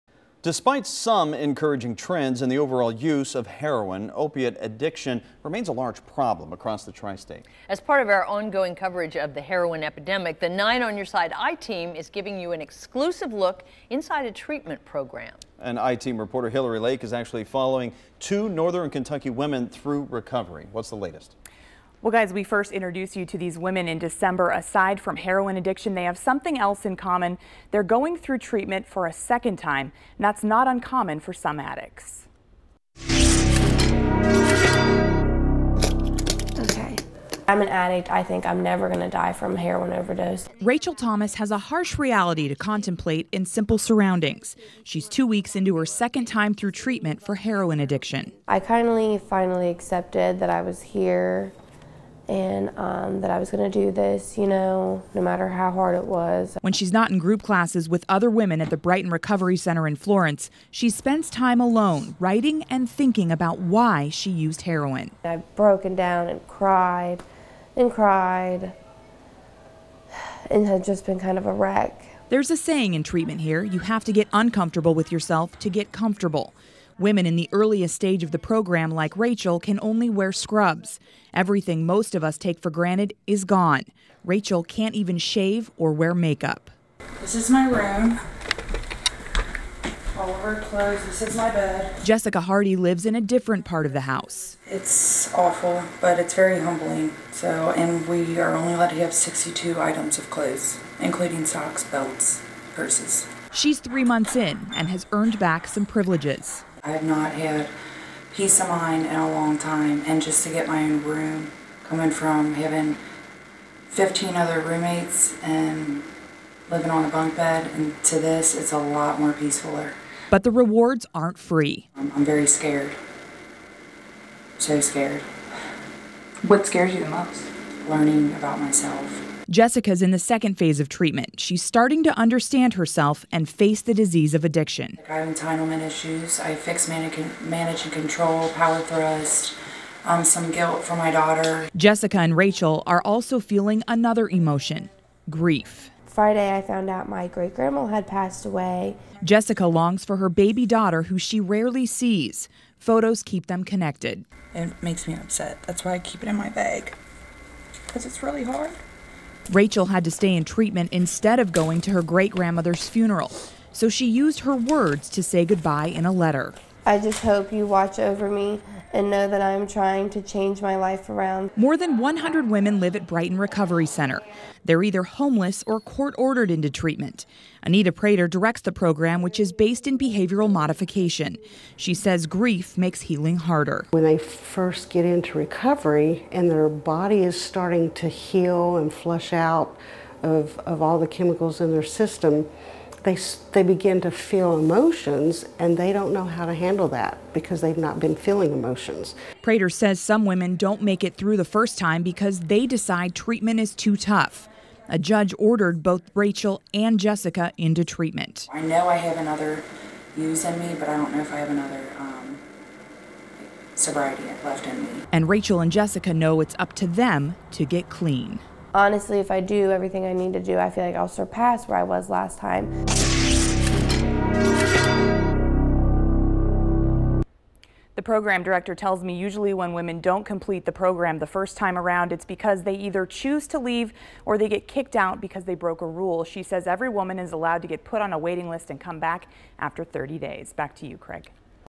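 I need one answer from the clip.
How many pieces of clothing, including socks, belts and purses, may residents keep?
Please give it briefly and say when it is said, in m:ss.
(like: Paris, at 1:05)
62, at 1:39.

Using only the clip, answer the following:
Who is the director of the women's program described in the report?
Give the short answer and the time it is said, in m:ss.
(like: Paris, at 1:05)
Anita Prater, at 2:57.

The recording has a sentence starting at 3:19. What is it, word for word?
Prater says some women don't make it through the first time because they decide treatment is too tough.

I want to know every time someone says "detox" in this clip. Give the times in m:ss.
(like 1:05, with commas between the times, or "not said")
not said.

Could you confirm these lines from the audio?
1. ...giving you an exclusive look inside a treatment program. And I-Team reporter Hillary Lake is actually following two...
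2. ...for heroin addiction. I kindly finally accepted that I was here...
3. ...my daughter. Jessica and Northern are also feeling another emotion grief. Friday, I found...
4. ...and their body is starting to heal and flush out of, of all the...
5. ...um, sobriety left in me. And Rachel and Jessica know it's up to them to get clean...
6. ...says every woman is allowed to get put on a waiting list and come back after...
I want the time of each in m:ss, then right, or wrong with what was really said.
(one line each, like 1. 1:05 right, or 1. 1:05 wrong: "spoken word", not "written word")
1. 0:12 right
2. 0:47 right
3. 2:20 wrong: "Rachel", not "Northern"
4. 3:06 right
5. 3:31 right
6. 3:56 right.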